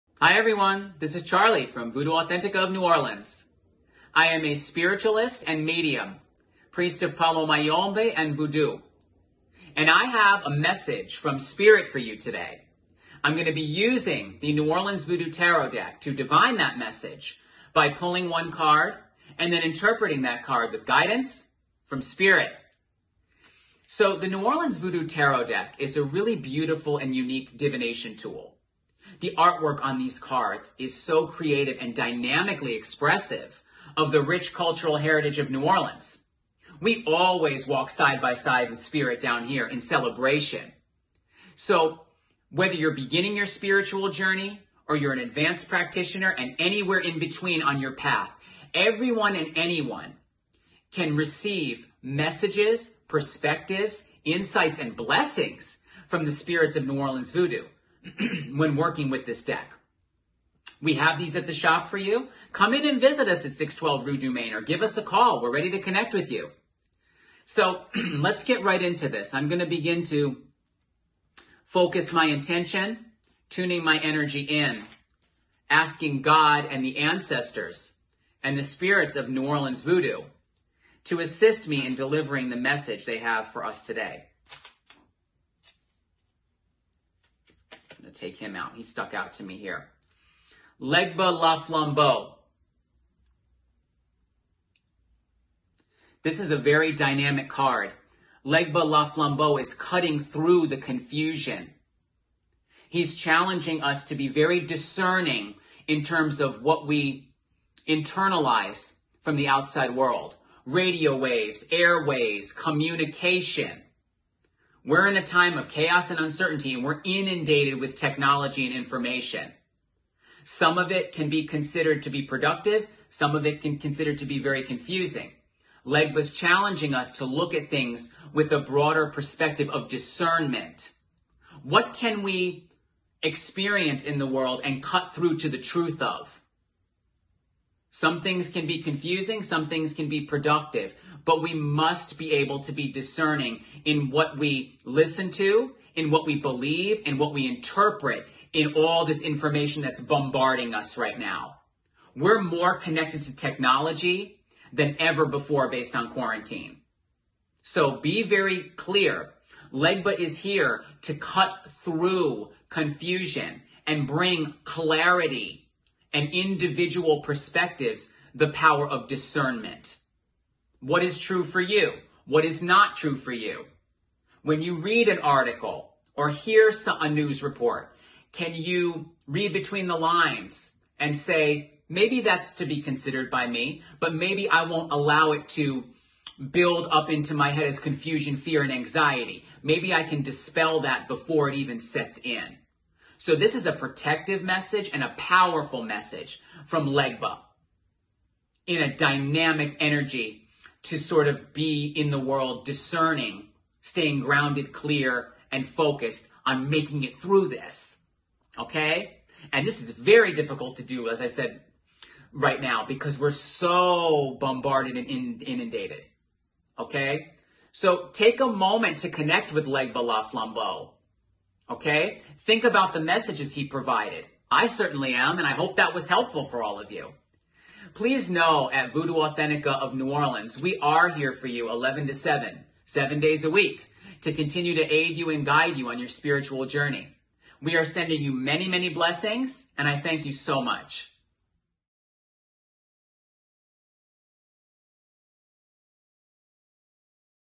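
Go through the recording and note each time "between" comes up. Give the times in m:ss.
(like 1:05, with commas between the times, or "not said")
0:47, 2:59.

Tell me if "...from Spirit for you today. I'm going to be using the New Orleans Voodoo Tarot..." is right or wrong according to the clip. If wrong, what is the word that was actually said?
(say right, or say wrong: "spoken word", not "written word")
right.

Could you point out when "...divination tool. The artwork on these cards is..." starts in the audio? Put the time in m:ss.
0:27.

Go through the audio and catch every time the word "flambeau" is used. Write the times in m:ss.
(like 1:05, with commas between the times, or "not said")
1:31, 1:39, 3:40.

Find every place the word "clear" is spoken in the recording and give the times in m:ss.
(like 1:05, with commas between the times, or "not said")
2:38, 3:24.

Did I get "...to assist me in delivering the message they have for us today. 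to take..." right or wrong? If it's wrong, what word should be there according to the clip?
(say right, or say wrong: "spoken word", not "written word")
right.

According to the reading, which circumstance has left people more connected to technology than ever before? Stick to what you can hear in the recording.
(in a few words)
Quarantine.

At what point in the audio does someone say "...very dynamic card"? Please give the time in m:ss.
1:36.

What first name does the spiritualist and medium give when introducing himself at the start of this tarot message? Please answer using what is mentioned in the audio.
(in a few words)
Charlie.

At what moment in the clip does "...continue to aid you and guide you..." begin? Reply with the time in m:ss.
3:54.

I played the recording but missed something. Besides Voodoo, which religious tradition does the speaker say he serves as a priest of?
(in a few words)
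Palo Mayombe.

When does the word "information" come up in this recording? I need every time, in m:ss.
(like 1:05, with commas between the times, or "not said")
1:58, 2:29.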